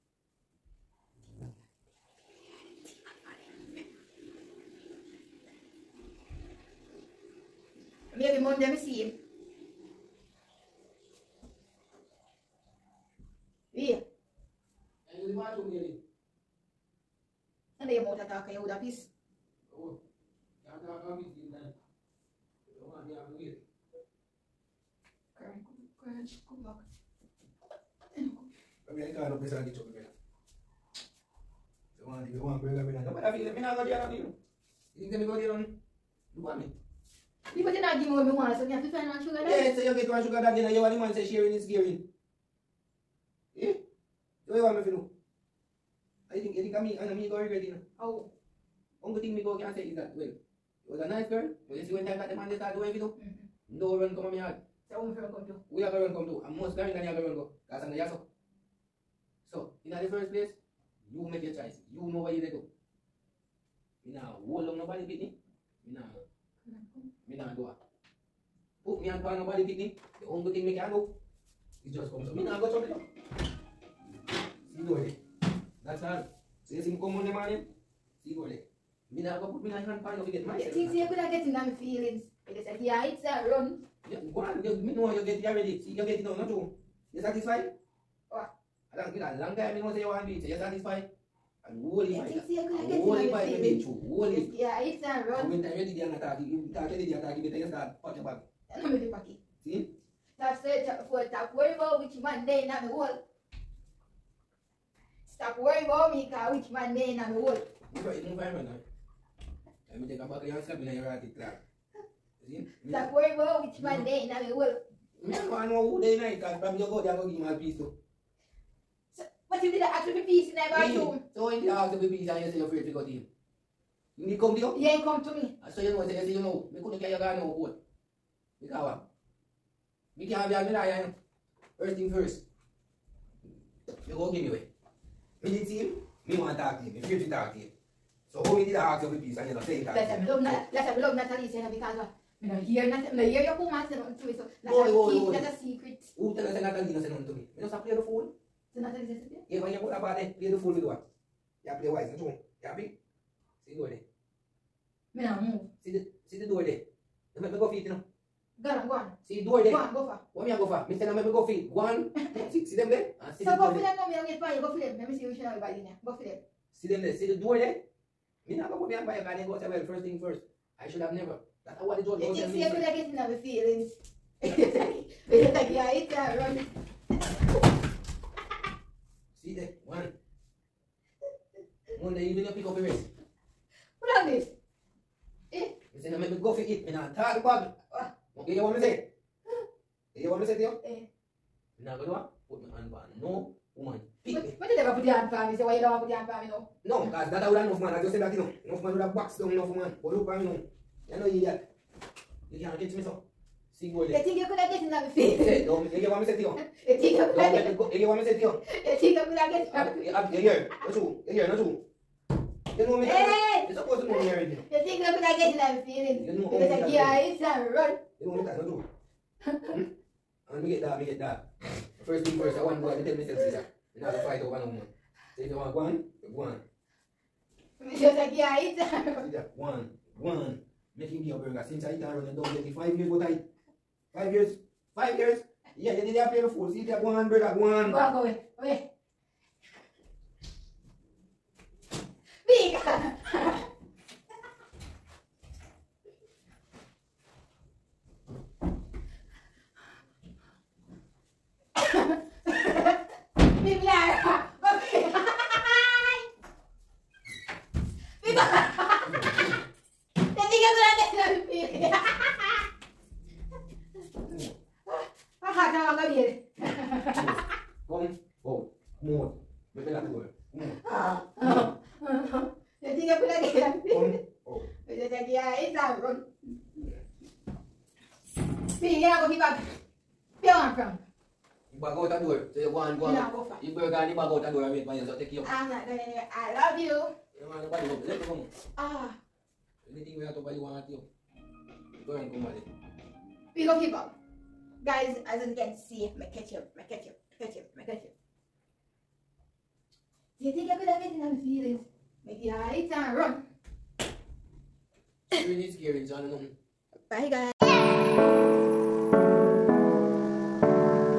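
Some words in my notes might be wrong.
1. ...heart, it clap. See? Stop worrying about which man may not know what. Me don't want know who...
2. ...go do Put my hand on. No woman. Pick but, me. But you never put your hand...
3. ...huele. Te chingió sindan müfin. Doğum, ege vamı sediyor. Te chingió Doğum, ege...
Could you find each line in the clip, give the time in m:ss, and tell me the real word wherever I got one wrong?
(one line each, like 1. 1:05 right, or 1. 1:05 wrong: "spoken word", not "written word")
1. 1:51 right
2. 3:11 right
3. 3:23 right.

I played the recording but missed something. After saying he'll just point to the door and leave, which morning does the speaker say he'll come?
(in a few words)
Monday morning.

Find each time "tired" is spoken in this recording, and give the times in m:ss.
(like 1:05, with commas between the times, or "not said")
3:07.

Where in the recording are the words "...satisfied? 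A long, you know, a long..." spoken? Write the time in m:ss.
1:27.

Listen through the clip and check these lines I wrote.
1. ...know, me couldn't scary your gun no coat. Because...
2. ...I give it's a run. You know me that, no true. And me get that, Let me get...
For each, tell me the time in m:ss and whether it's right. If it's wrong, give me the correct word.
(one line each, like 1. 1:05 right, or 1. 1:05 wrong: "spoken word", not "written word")
1. 2:06 wrong: "carry", not "scary"
2. 3:36 right.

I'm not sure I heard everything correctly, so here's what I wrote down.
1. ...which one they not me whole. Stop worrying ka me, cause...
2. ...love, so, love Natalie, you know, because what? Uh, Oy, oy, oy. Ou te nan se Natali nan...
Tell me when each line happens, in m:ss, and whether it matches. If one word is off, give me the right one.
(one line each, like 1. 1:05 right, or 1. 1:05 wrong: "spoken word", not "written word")
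1. 1:42 right
2. 2:20 right.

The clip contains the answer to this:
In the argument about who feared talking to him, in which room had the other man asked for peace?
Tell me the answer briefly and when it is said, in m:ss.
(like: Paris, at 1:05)
bathroom, at 2:00.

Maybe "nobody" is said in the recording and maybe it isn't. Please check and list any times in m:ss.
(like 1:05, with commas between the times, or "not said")
1:04, 1:09.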